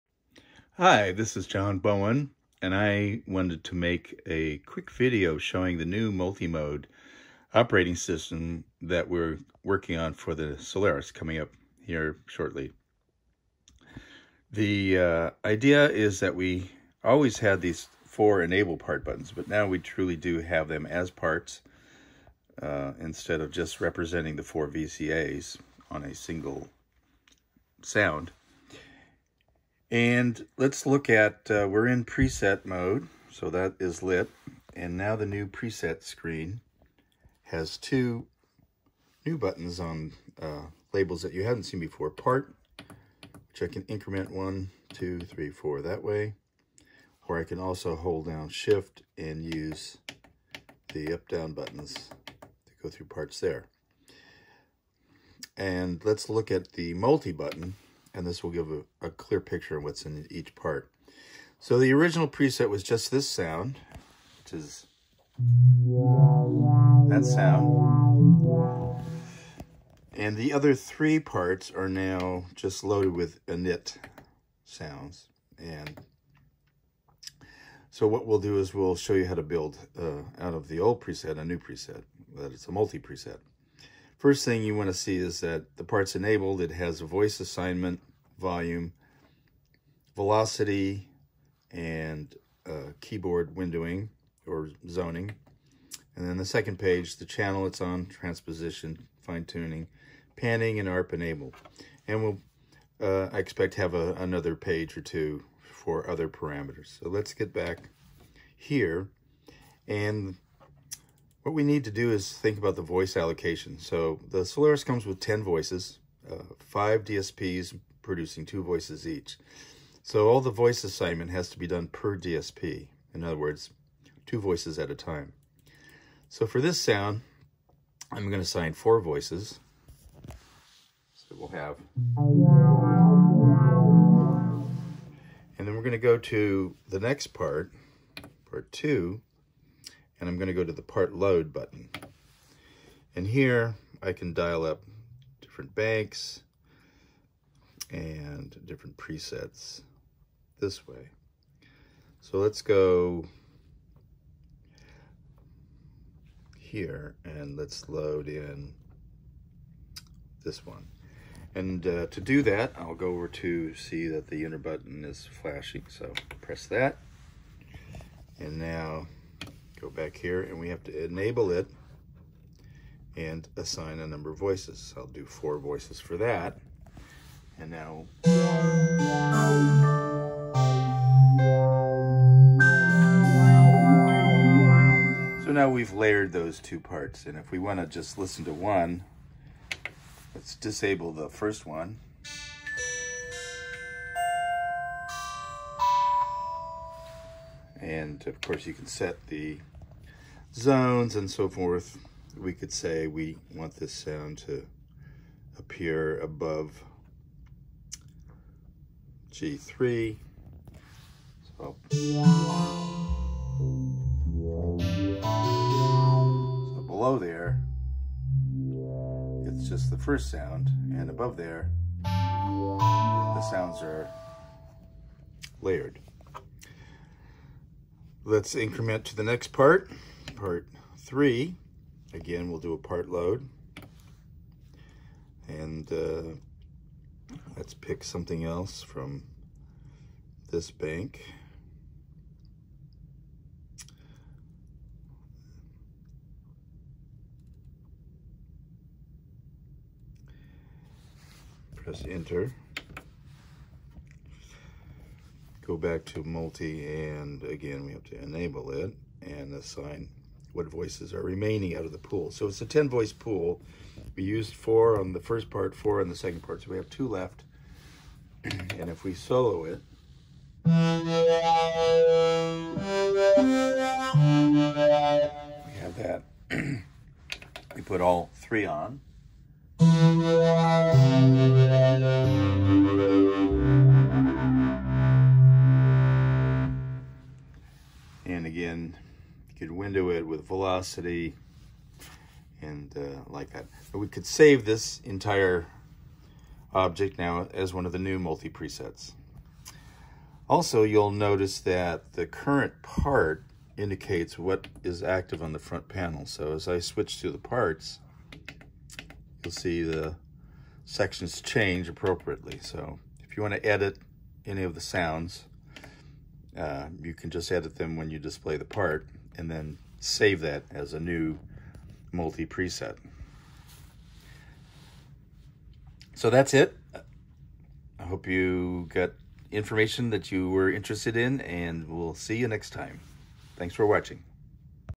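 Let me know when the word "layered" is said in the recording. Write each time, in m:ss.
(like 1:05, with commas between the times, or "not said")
3:05, 3:45.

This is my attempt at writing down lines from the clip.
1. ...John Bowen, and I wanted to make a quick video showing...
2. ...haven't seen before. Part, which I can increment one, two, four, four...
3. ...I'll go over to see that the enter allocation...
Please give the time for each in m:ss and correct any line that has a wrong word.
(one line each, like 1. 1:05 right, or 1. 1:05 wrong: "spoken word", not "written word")
1. 0:01 right
2. 0:41 wrong: "three", not "four"
3. 2:42 wrong: "button", not "allocation".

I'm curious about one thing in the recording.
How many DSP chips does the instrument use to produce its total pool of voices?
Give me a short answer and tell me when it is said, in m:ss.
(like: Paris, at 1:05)
5, at 1:56.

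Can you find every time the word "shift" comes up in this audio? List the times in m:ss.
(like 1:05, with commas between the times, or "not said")
0:48.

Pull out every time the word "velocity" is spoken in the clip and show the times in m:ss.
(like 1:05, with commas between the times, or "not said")
1:30, 4:50.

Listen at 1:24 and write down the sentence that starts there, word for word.
First thing you want to see is that the part's enabled.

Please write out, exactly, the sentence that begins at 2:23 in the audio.
And here I can dial up different banks, and different presets this way.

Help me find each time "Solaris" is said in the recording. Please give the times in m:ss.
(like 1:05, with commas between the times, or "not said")
0:10, 1:54.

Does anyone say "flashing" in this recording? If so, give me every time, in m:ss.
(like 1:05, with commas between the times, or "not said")
2:45.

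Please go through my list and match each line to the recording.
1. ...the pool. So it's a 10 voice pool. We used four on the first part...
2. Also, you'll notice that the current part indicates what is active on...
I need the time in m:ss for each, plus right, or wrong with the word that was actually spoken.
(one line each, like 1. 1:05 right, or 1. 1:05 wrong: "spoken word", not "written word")
1. 4:21 right
2. 5:00 right.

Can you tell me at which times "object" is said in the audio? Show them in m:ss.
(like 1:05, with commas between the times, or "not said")
4:56.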